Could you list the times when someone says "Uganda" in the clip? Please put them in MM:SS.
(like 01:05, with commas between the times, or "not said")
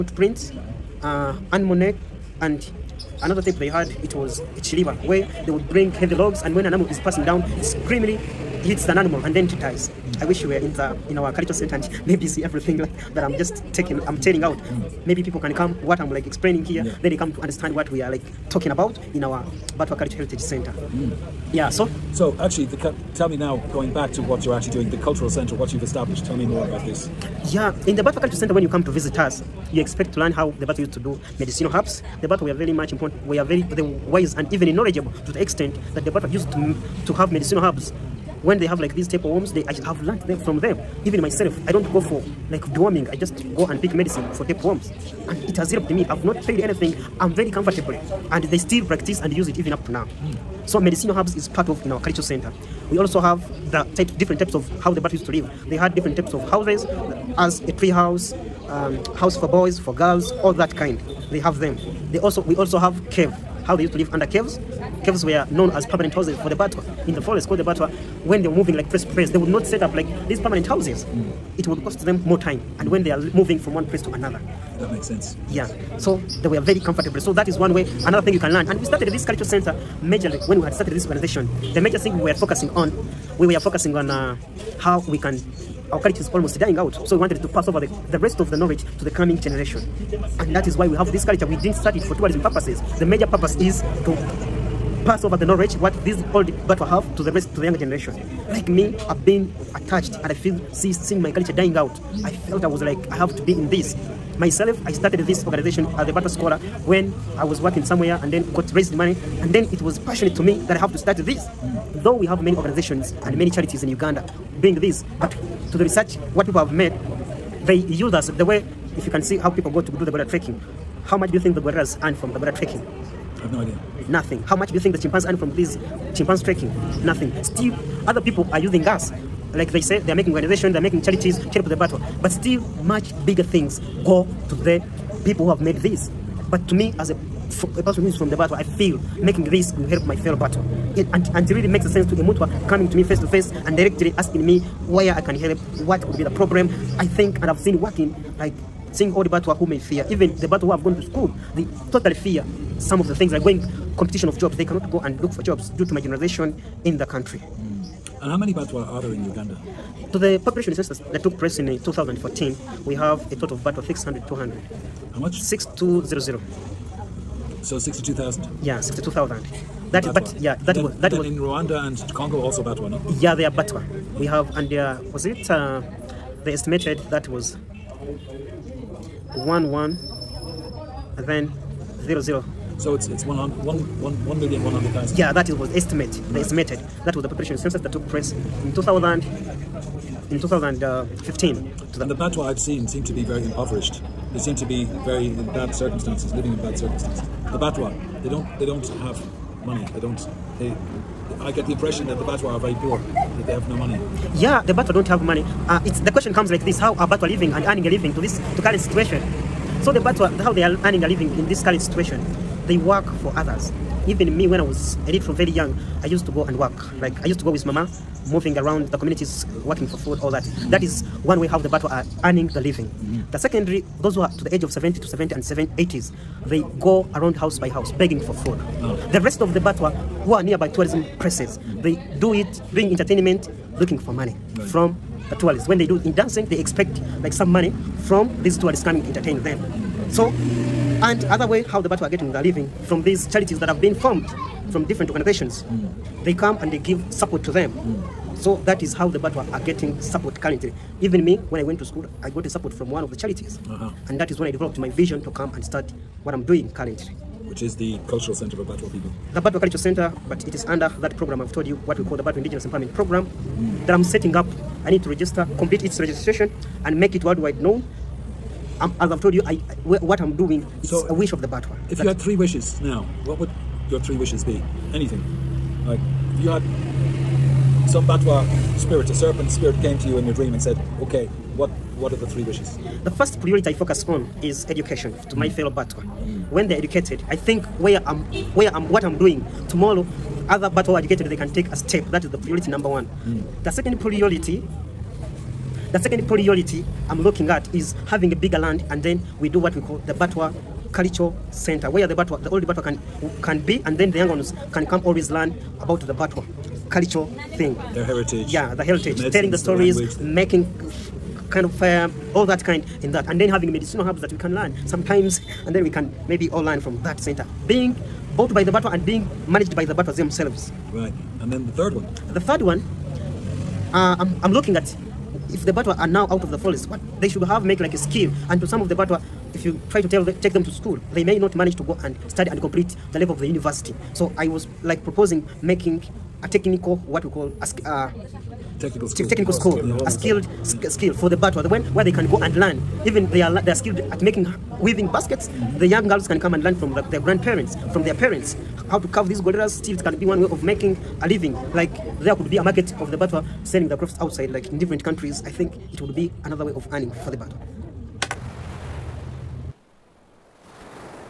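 01:53, 02:39.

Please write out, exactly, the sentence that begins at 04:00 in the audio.
So, and other way how the Batwa are getting their living from these charities that have been formed from different organizations.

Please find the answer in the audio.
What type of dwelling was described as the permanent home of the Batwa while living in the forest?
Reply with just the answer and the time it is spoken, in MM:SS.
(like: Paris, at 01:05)
Caves, at 01:05.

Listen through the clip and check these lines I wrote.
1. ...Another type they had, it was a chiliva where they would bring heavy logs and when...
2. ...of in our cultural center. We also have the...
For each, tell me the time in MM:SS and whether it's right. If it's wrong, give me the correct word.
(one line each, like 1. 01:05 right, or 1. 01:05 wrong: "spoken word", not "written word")
1. 00:03 right
2. 00:51 right.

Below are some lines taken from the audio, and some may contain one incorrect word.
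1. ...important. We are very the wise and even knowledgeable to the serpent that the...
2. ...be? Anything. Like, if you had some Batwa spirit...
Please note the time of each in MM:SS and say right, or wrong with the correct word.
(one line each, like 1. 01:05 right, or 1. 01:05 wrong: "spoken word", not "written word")
1. 00:32 wrong: "extent", not "serpent"
2. 04:34 right.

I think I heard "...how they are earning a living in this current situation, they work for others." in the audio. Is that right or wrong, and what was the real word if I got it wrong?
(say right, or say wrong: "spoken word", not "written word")
right.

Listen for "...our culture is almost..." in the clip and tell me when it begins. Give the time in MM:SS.
01:25.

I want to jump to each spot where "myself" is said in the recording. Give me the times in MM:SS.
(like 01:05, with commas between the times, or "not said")
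00:41, 01:44.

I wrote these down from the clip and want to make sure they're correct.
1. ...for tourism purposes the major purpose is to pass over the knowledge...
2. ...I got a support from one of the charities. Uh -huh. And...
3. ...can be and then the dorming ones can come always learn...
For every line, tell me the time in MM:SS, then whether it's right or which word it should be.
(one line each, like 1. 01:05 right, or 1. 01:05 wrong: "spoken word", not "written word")
1. 01:32 right
2. 04:12 right
3. 05:03 wrong: "young", not "dorming".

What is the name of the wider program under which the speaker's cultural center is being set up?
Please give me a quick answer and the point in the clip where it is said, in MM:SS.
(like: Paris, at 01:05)
Batwa Indigenous Empowerment Program, at 04:22.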